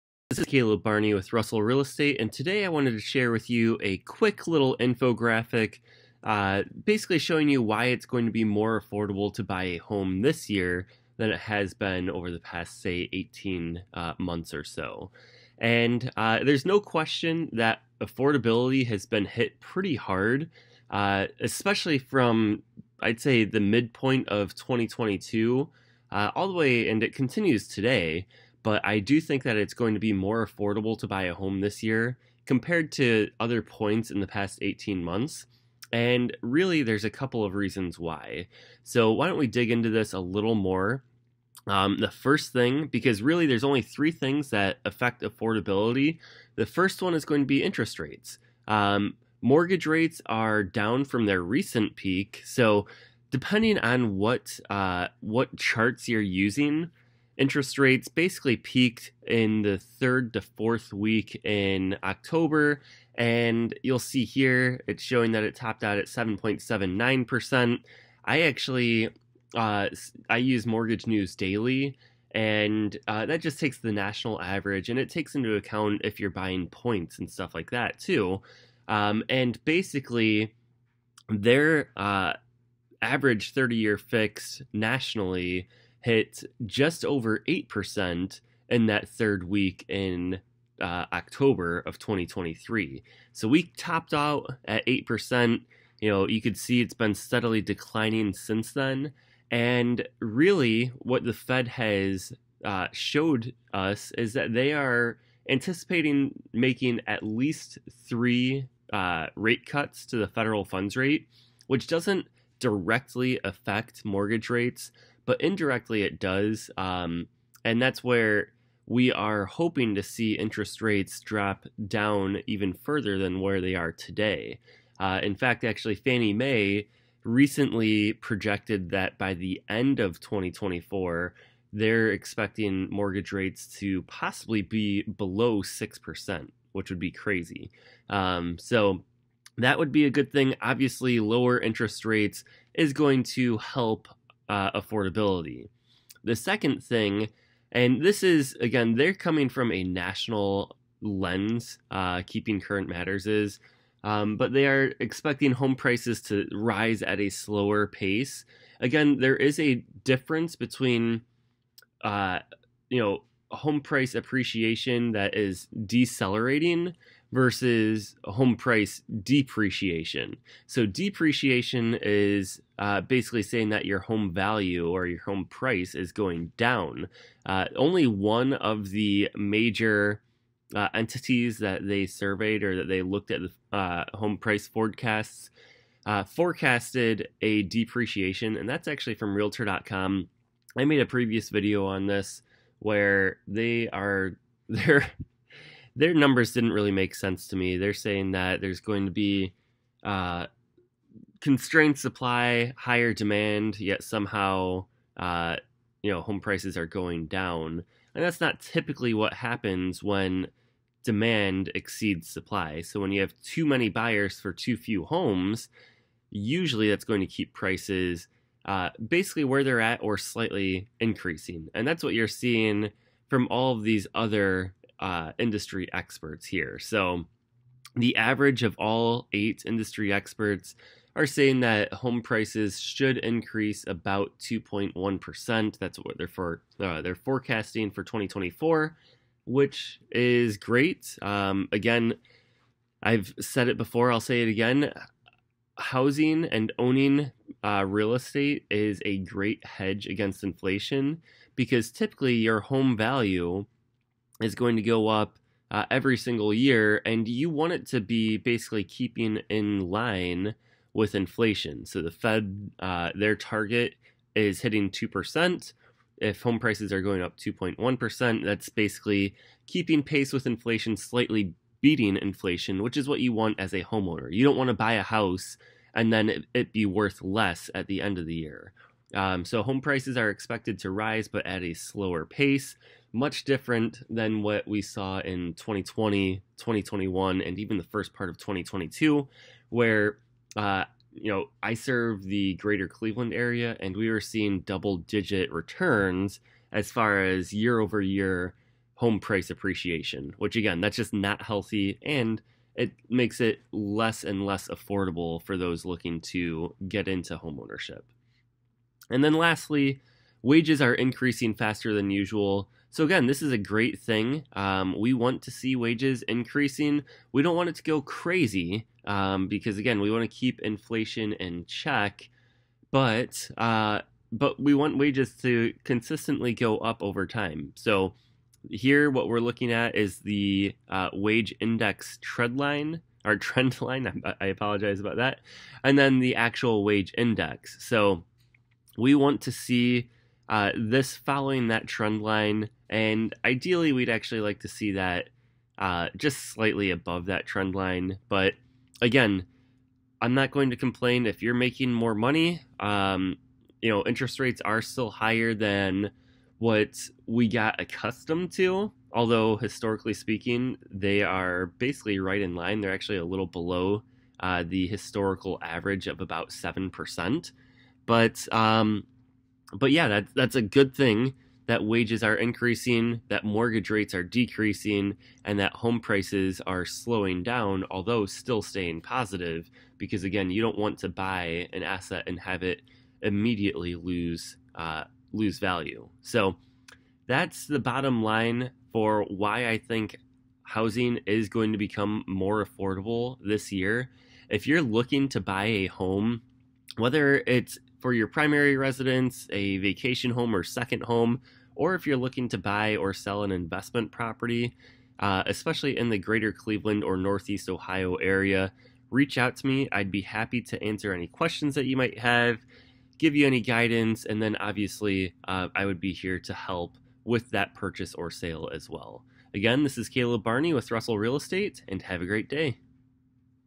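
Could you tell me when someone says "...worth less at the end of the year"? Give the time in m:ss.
4:36.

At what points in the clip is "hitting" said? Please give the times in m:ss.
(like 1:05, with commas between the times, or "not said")
4:24.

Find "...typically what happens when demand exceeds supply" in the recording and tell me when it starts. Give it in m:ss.
3:28.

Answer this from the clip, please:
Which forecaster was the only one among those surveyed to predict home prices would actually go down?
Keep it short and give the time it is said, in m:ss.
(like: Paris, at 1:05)
Realtor.com, at 3:09.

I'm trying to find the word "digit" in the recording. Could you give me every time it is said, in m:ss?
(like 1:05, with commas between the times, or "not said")
4:54.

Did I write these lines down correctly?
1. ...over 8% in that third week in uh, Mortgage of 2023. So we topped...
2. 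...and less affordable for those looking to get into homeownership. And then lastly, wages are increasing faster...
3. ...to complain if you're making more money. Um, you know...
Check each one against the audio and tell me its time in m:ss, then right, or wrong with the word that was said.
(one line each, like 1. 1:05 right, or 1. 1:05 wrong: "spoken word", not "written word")
1. 1:27 wrong: "October", not "Mortgage"
2. 5:04 right
3. 5:50 right.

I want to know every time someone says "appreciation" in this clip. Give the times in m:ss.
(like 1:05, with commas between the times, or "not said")
2:44, 4:59.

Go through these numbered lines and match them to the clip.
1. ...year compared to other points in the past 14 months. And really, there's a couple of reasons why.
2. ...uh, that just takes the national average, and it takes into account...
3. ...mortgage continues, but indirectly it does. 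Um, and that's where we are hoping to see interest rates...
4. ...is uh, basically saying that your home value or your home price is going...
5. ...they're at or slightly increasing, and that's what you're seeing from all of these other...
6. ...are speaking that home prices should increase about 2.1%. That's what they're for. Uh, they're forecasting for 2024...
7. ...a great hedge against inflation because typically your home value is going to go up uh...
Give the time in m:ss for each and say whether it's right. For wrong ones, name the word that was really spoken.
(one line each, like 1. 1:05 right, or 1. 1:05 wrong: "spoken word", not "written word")
1. 0:31 wrong: "18", not "14"
2. 1:13 right
3. 1:54 wrong: "rates", not "continues"
4. 2:52 right
5. 3:39 right
6. 3:51 wrong: "saying", not "speaking"
7. 4:09 right.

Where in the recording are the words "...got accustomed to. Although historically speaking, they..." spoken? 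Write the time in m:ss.
5:57.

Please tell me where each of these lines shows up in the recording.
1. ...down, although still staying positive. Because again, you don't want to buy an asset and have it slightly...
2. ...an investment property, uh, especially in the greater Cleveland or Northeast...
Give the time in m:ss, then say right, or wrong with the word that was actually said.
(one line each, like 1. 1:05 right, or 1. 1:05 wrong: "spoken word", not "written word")
1. 6:17 wrong: "immediately", not "slightly"
2. 6:43 right.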